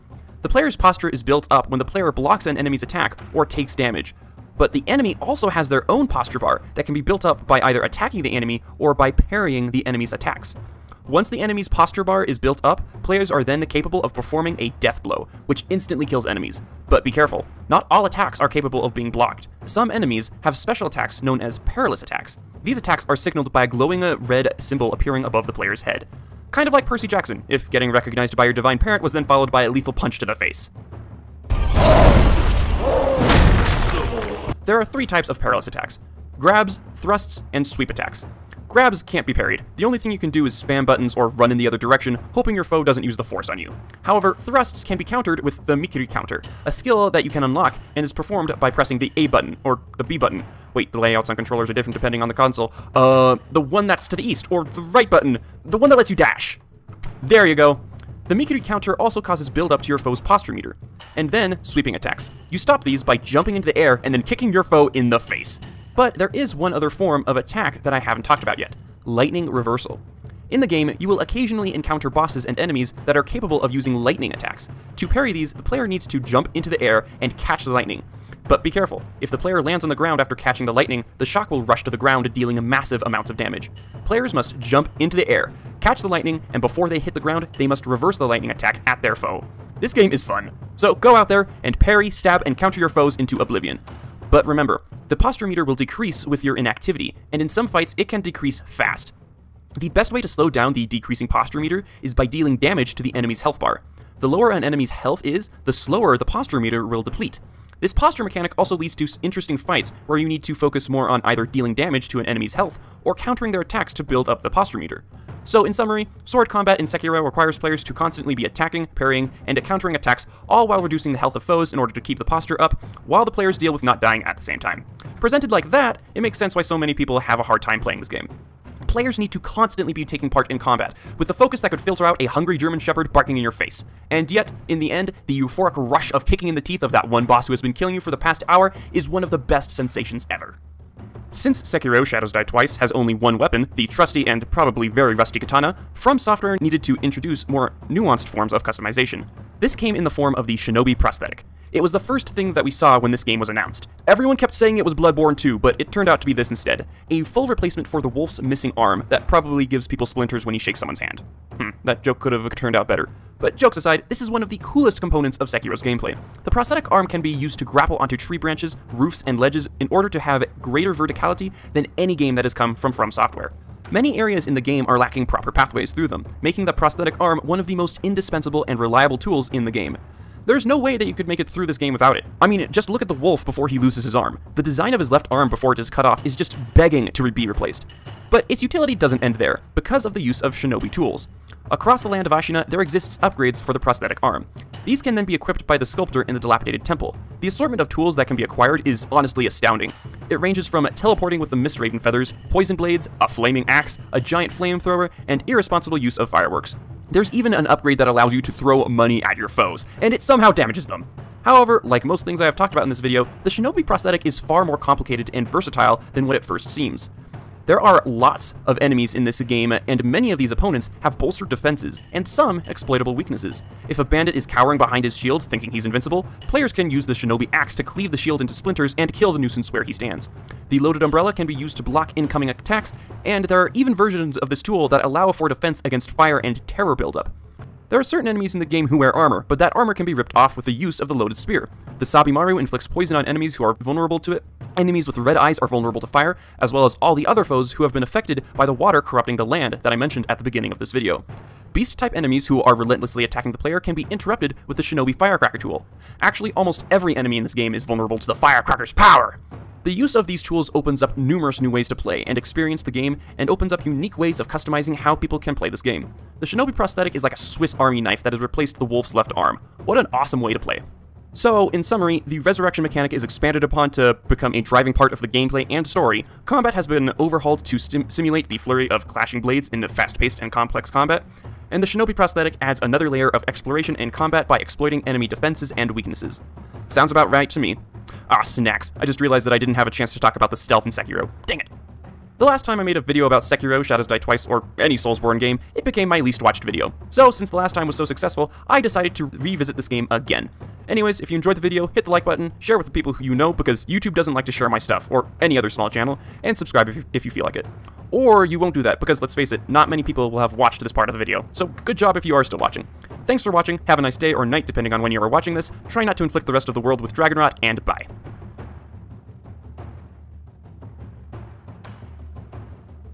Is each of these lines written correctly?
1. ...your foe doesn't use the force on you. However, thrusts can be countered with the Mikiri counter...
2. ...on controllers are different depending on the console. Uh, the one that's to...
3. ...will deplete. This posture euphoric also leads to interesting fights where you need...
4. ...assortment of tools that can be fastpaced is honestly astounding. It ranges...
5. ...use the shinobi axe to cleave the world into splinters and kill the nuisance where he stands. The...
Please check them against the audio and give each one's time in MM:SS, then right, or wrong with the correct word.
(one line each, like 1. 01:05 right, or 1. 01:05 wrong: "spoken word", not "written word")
1. 00:42 right
2. 00:51 right
3. 01:46 wrong: "mechanic", not "euphoric"
4. 03:17 wrong: "acquired", not "fastpaced"
5. 03:46 wrong: "shield", not "world".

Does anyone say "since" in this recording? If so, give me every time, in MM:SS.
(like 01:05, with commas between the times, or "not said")
02:21, 04:57.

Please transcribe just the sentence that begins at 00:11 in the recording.
Once the enemy's posture bar is built up, players are then capable of performing a death blow, which instantly kills enemies.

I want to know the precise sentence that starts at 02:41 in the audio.
Hmm, that joke could have turned out better.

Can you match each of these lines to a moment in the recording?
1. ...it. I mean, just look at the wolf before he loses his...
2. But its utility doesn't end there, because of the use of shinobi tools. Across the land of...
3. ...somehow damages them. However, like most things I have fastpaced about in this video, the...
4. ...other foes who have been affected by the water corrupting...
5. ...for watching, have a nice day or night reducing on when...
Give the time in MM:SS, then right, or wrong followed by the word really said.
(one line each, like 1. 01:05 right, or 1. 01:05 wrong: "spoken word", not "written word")
1. 03:02 right
2. 03:08 right
3. 03:30 wrong: "talked", not "fastpaced"
4. 04:07 right
5. 05:13 wrong: "depending", not "reducing".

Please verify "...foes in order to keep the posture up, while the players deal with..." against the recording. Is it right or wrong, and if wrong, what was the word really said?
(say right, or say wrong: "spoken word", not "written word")
right.